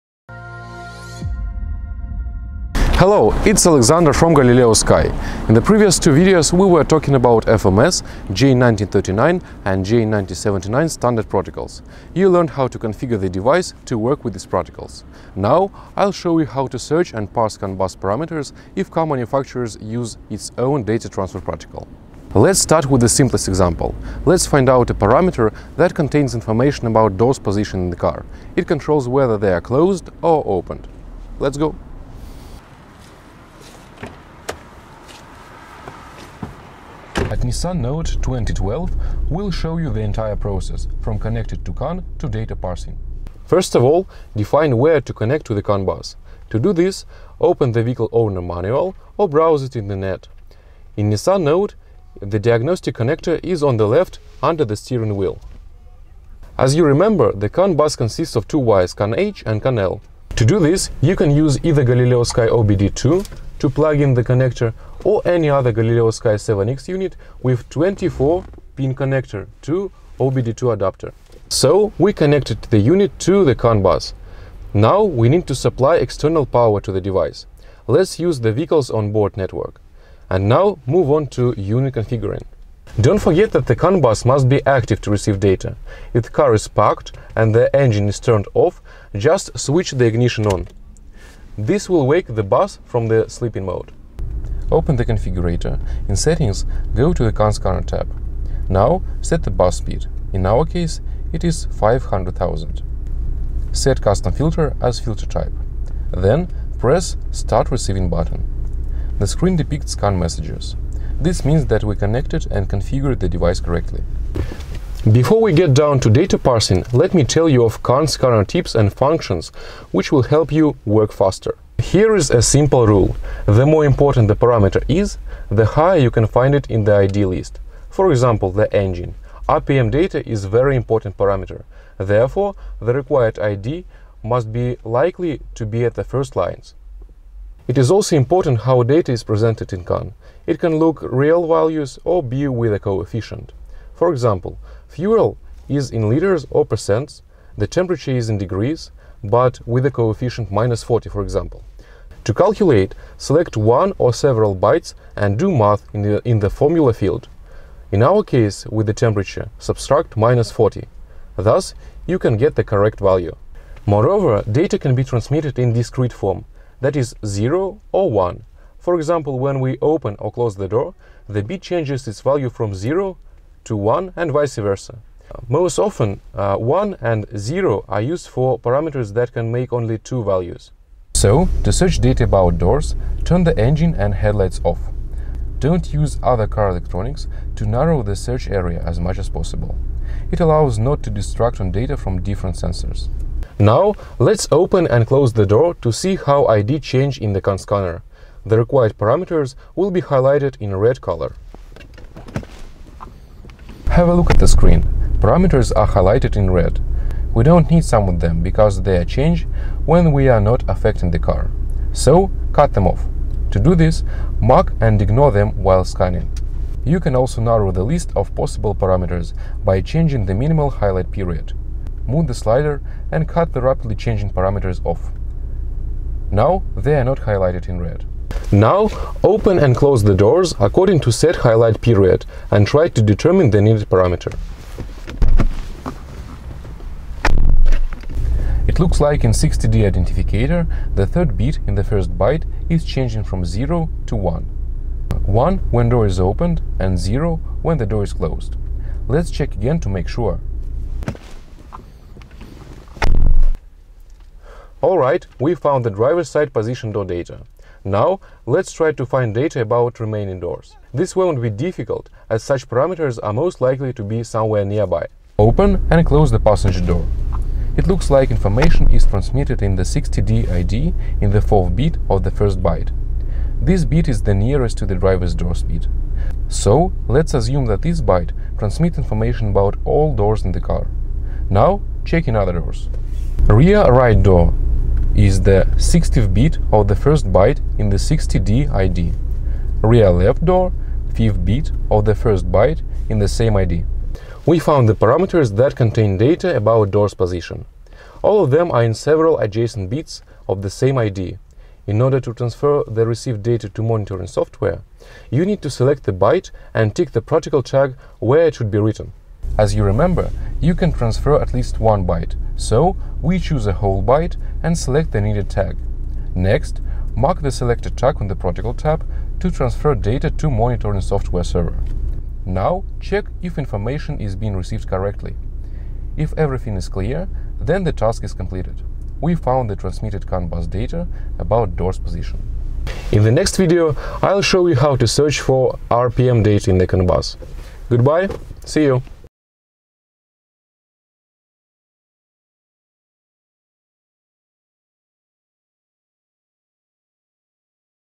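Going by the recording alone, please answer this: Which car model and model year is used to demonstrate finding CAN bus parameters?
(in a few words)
Nissan Note 2012.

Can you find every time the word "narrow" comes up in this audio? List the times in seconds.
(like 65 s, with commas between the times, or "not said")
187 s, 217 s.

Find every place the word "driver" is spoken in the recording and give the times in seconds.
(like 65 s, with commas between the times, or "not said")
255 s, 274 s.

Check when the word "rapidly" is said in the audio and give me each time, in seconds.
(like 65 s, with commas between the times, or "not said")
223 s.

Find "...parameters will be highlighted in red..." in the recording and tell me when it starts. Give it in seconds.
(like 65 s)
198 s.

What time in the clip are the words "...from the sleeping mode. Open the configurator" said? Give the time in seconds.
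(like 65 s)
92 s.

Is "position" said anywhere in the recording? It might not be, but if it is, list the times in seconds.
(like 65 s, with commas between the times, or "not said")
27 s, 256 s, 297 s, 331 s.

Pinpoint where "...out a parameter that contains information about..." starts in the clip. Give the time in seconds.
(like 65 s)
24 s.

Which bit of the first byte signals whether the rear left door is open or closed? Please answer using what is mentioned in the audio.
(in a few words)
5th bit.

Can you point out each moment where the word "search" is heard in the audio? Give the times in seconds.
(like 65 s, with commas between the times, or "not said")
16 s, 181 s, 188 s, 335 s.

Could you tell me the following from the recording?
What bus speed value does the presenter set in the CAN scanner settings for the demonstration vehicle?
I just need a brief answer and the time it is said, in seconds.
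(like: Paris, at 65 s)
500,000, at 101 s.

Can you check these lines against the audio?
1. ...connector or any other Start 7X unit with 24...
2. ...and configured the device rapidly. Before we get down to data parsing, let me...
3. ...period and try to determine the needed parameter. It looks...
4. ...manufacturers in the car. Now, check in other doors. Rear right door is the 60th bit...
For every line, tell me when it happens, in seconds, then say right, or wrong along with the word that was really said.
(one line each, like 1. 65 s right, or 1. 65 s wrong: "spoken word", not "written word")
1. 64 s wrong: "Galileosky", not "Start"
2. 112 s wrong: "correctly", not "rapidly"
3. 231 s right
4. 280 s wrong: "doors", not "manufacturers".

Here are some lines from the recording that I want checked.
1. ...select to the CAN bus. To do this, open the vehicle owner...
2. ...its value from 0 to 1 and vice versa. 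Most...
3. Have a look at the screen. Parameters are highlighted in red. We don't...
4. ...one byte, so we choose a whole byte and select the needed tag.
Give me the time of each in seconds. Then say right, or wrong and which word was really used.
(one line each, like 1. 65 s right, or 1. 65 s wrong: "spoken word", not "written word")
1. 45 s wrong: "connect", not "select"
2. 172 s right
3. 203 s right
4. 311 s right.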